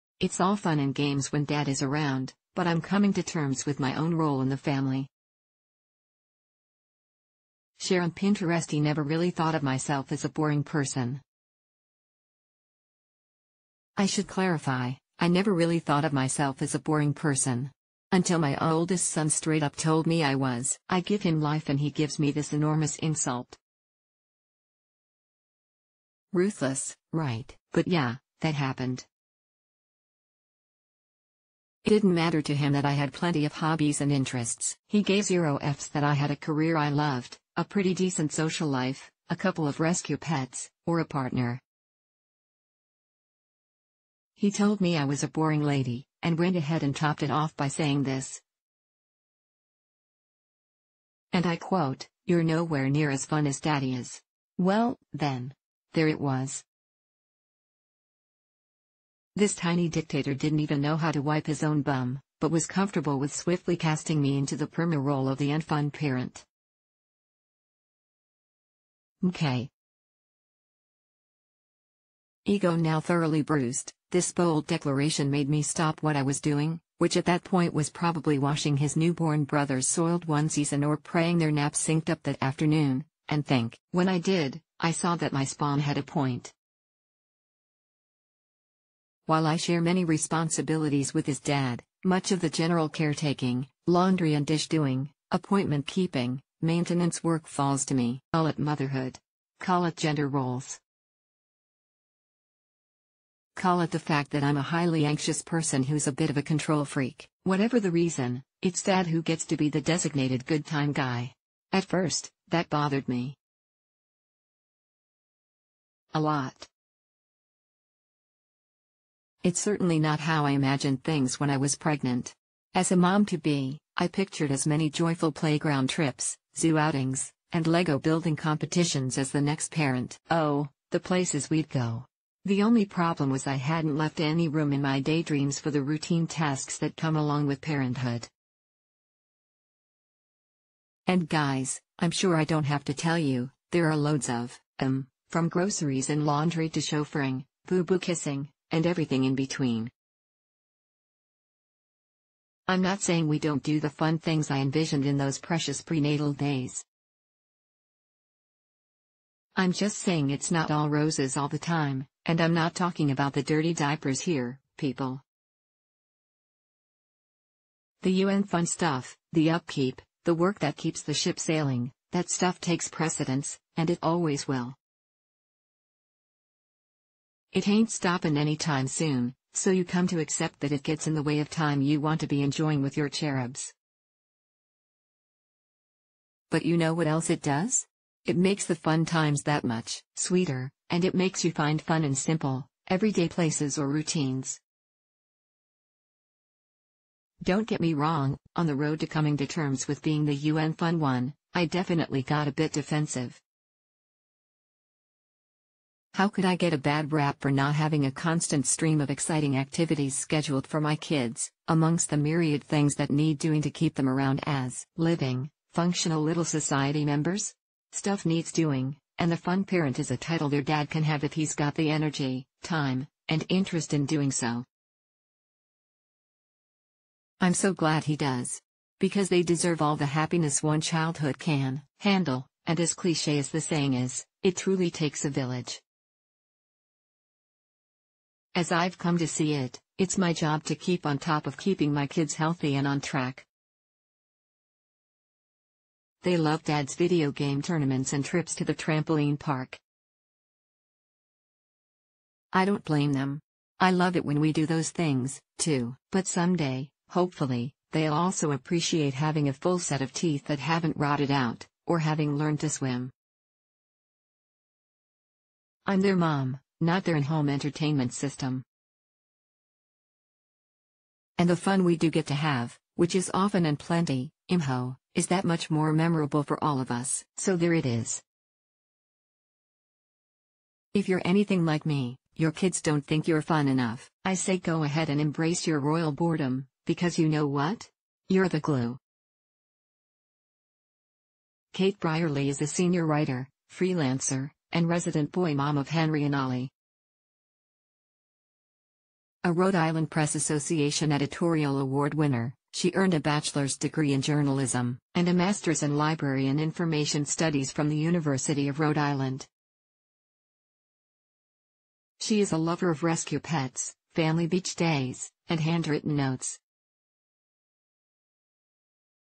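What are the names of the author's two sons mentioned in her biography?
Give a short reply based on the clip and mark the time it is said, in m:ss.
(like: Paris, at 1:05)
Henry and Ollie, at 4:55.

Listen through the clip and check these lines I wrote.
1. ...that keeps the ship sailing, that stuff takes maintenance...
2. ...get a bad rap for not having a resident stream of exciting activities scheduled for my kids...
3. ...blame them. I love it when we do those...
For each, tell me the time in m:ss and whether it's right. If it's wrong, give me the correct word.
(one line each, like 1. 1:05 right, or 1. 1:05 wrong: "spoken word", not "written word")
1. 2:50 wrong: "precedence", not "maintenance"
2. 3:26 wrong: "constant", not "resident"
3. 4:12 right.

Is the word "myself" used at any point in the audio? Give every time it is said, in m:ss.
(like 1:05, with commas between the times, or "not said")
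0:09, 0:16.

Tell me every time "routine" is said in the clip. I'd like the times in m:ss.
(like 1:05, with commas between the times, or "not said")
2:15, 3:13.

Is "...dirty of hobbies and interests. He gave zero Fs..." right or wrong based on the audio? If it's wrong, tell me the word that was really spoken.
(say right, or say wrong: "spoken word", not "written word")
wrong: "plenty", not "dirty".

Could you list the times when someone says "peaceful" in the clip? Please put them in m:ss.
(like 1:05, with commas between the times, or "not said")
not said.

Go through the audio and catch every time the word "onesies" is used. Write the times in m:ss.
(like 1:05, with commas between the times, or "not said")
1:20.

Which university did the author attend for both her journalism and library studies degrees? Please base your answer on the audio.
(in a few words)
University of Rhode Island.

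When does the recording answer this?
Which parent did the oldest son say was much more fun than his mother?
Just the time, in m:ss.
0:53.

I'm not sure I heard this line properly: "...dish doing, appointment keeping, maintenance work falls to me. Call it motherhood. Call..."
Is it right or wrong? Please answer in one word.
right.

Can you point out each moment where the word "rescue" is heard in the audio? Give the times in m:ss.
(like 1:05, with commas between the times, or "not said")
0:39, 5:13.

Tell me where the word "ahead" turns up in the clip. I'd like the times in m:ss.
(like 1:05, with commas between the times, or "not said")
0:46, 4:44.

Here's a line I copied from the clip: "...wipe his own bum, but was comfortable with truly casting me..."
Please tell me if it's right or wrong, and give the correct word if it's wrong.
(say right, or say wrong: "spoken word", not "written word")
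wrong: "swiftly", not "truly".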